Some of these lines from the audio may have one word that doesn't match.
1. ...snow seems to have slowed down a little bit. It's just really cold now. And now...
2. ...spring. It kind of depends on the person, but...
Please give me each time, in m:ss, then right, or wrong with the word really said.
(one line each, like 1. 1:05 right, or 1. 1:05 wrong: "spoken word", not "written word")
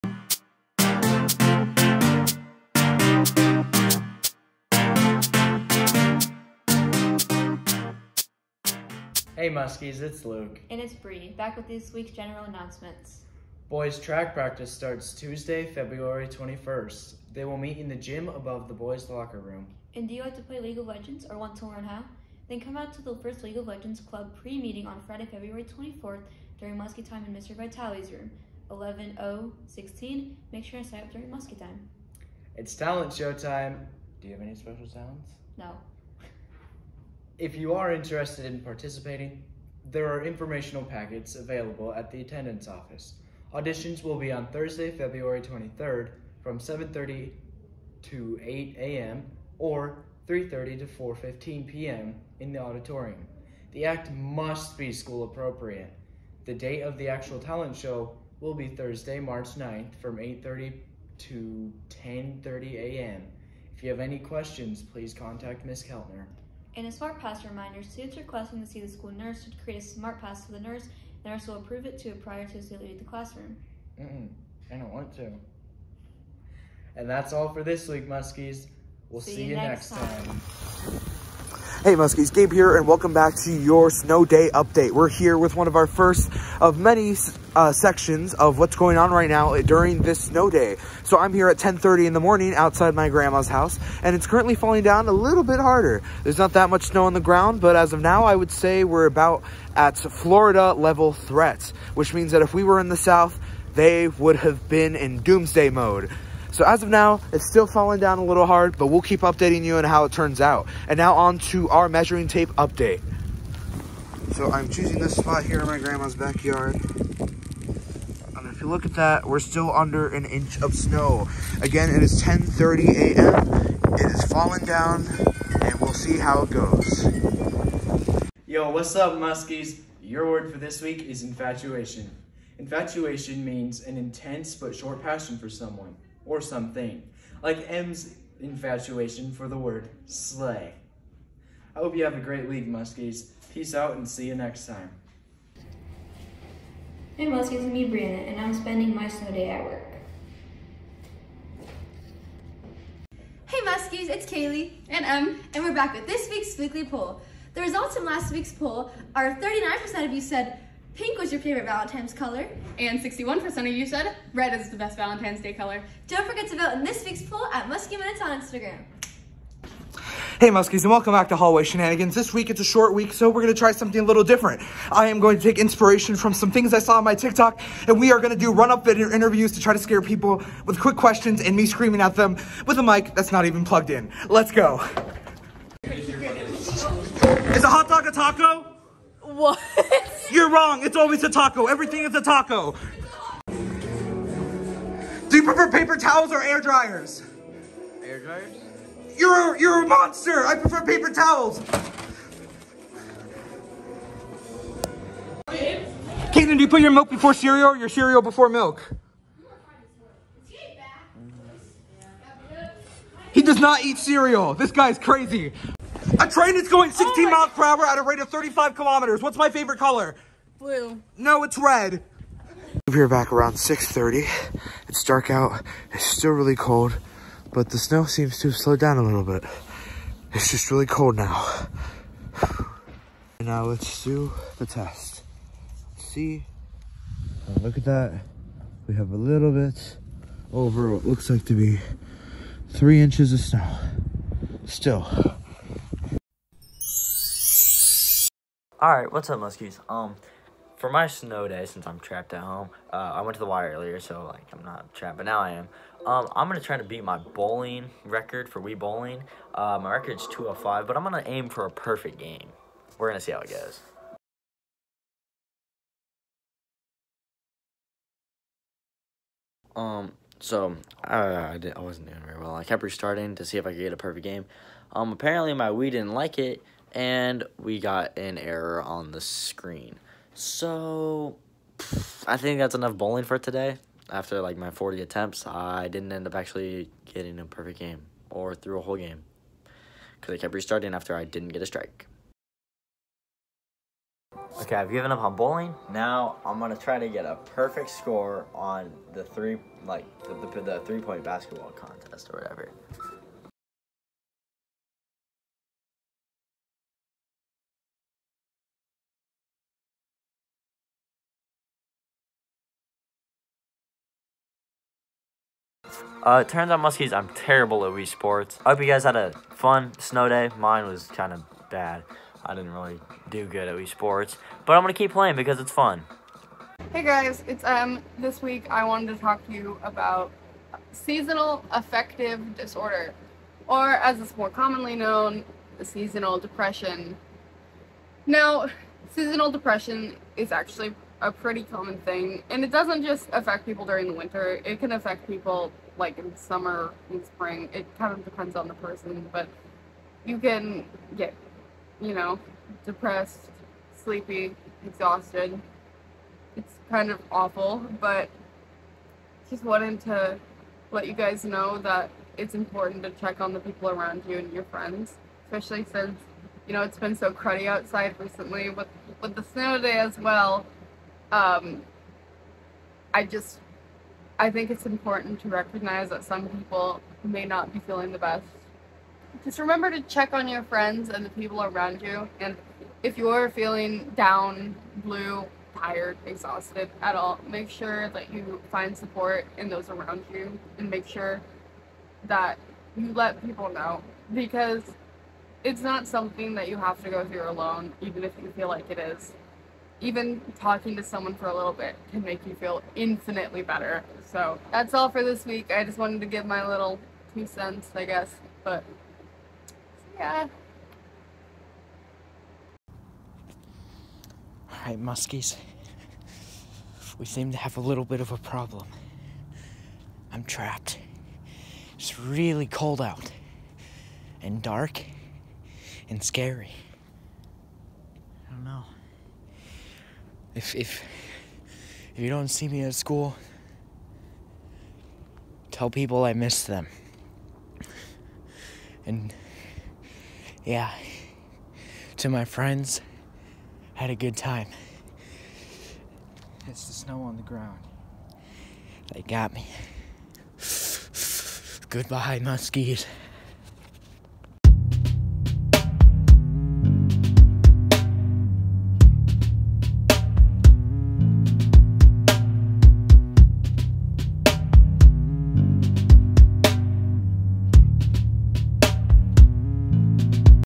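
1. 3:47 right
2. 5:47 right.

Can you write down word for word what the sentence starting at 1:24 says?
We're here with one of our first of many uh, sections of what's going on right now during this snow day.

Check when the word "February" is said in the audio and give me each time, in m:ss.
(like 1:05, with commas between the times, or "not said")
0:15, 0:25, 0:44.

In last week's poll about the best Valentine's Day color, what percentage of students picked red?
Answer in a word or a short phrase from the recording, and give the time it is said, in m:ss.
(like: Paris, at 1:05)
61%, at 2:42.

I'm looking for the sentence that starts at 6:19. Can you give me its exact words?
Just remember to check on your friends and the people around you.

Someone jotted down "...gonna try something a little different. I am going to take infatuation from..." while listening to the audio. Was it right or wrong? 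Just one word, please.
wrong.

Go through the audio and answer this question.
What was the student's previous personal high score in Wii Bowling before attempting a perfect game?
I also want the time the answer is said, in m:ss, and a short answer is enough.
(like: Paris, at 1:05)
205, at 4:20.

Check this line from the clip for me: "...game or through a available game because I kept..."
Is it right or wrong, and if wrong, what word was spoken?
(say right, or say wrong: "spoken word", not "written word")
wrong: "whole", not "available".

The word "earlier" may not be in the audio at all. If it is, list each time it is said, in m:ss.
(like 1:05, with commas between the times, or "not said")
4:13.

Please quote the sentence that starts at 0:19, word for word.
And do you like to play League of Legends or want to learn how?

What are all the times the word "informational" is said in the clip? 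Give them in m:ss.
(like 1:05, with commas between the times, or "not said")
0:40.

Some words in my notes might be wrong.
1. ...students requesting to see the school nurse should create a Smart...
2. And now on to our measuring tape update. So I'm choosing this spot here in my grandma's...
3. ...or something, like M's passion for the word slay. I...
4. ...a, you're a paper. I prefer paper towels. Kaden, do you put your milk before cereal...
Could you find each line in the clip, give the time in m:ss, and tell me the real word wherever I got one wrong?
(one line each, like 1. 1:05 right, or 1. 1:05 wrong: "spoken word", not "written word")
1. 1:07 right
2. 1:50 right
3. 2:16 wrong: "infatuation", not "passion"
4. 3:19 wrong: "monster", not "paper".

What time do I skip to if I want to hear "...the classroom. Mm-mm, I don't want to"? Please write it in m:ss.
1:12.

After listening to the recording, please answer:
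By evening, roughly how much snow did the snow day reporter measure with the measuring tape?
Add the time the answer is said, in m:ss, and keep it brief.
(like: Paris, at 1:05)
3 inches, at 4:02.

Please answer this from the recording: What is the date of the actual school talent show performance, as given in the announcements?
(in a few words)
Thursday, March 9th.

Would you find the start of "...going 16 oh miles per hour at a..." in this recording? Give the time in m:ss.
3:36.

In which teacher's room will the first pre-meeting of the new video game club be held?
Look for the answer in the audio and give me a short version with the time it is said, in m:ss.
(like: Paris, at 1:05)
Mr. Vitale's room, at 0:27.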